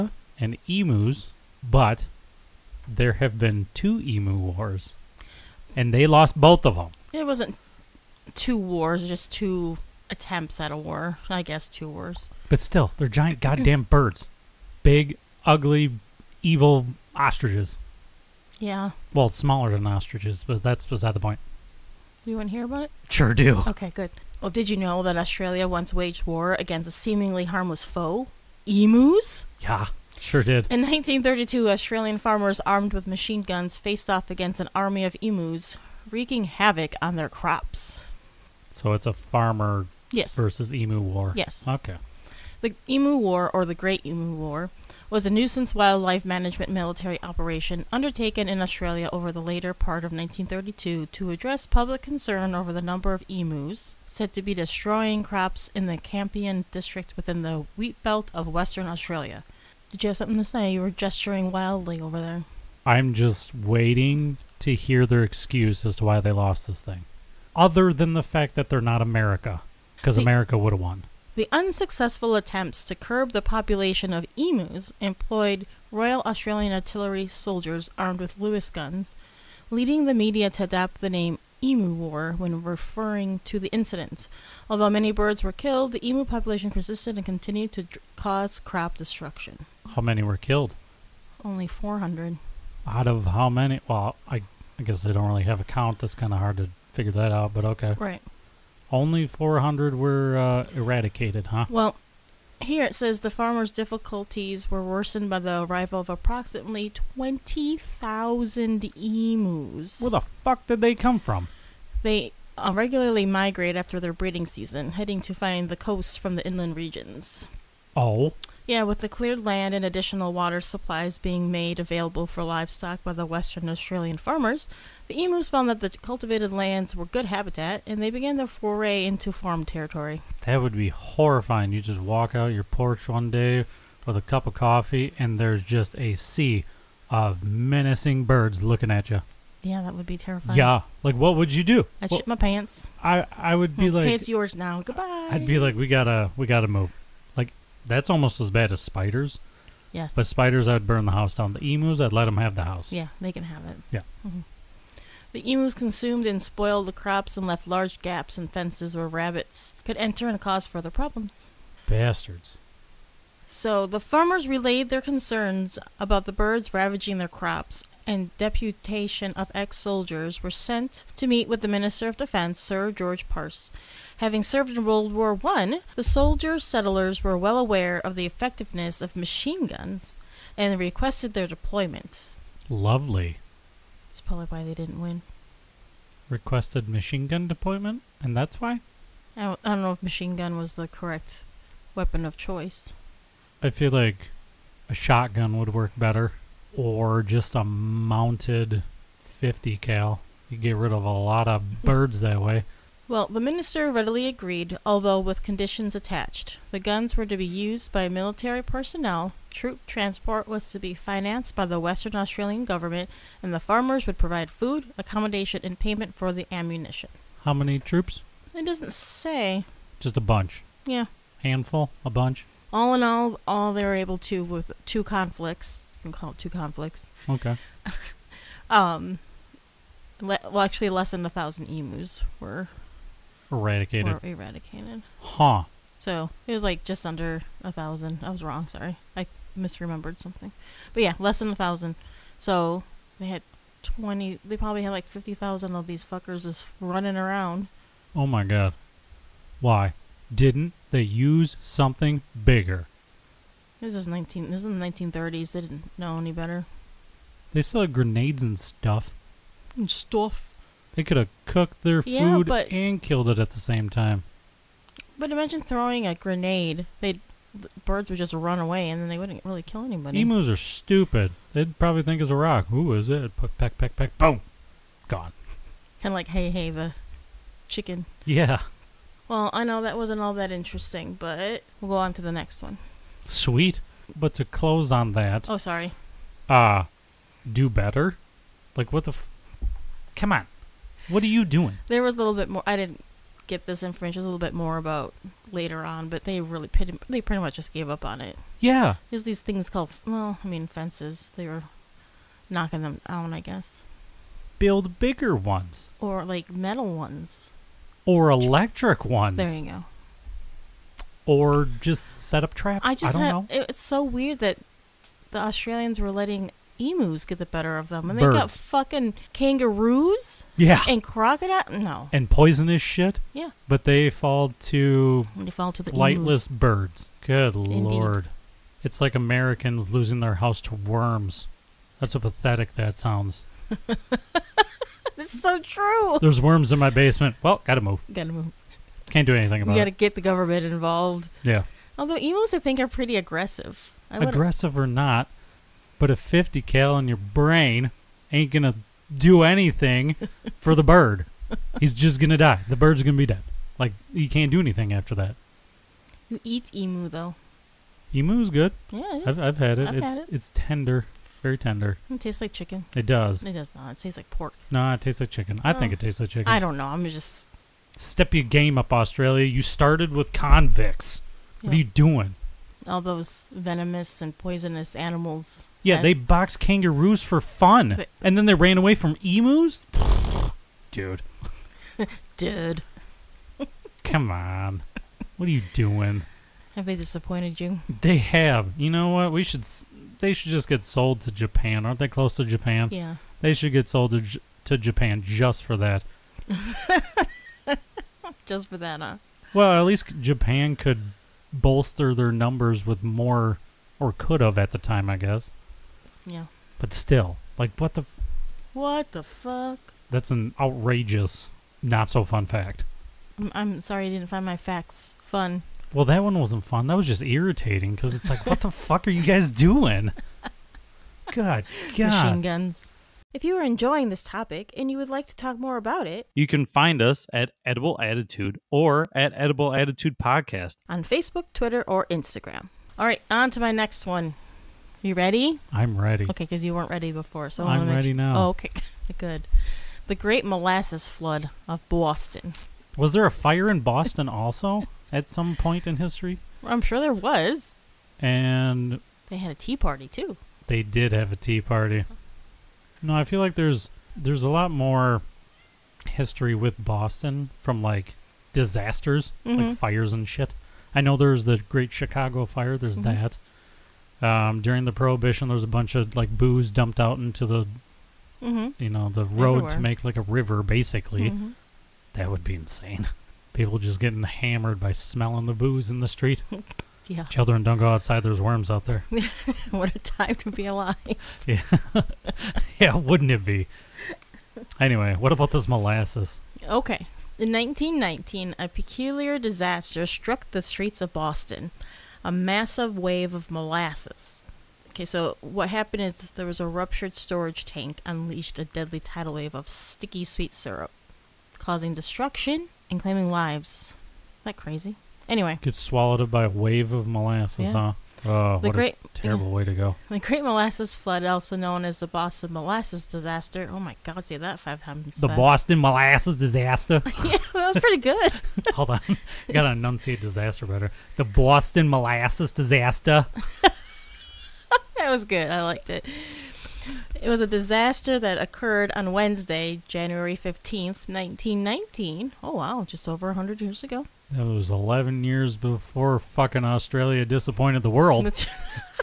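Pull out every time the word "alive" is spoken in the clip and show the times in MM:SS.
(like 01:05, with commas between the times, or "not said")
08:00.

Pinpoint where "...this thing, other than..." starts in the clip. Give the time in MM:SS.
01:06.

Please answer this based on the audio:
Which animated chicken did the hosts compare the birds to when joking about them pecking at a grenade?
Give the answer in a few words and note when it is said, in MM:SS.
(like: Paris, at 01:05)
Hei Hei, at 04:36.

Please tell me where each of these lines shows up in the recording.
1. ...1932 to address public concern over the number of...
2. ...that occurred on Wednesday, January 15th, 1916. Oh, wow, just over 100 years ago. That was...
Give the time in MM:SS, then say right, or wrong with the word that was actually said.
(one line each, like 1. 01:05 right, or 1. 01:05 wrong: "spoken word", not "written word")
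1. 00:50 right
2. 08:48 wrong: "1919", not "1916".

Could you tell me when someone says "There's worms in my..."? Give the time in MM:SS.
05:36.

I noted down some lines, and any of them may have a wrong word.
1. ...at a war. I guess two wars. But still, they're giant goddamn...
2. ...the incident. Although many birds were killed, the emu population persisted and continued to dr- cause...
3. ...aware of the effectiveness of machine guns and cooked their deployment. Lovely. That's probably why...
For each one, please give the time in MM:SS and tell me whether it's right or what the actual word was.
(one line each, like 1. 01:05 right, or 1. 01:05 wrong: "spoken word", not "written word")
1. 00:10 right
2. 01:23 right
3. 02:57 wrong: "requested", not "cooked".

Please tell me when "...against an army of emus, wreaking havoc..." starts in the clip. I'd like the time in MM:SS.
00:34.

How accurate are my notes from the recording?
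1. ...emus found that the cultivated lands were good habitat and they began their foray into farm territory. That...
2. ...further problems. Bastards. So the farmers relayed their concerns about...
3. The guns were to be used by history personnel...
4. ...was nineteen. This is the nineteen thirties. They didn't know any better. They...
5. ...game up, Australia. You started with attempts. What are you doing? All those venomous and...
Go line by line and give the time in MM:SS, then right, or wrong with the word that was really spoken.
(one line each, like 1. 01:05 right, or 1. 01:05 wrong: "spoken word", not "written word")
1. 02:05 right
2. 02:40 right
3. 03:26 wrong: "military", not "history"
4. 04:13 right
5. 06:08 wrong: "convicts", not "attempts".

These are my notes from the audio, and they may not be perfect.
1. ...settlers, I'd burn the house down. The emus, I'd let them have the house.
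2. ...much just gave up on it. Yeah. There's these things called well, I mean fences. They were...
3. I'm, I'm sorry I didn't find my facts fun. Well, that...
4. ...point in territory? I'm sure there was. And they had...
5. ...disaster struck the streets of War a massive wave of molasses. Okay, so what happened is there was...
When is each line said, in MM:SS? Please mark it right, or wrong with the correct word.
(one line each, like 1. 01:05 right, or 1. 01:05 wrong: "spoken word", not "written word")
1. 02:30 wrong: "spiders", not "settlers"
2. 04:57 right
3. 06:53 right
4. 07:25 wrong: "history", not "territory"
5. 08:09 wrong: "Boston", not "War".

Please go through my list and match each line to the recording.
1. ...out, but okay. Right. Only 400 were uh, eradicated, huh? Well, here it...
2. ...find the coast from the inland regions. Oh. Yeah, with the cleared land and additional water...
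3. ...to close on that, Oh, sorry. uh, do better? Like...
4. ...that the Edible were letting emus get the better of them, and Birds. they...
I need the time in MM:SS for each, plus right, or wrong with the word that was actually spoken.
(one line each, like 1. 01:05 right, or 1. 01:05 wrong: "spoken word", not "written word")
1. 01:37 right
2. 01:55 right
3. 04:44 right
4. 05:14 wrong: "Australians", not "Edible".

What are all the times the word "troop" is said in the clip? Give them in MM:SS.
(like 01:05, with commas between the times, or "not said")
03:29, 03:37.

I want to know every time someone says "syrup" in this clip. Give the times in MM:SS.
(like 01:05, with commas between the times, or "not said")
08:20.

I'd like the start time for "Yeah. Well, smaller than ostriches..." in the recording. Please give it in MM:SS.
00:18.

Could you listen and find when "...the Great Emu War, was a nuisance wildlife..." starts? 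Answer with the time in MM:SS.
00:43.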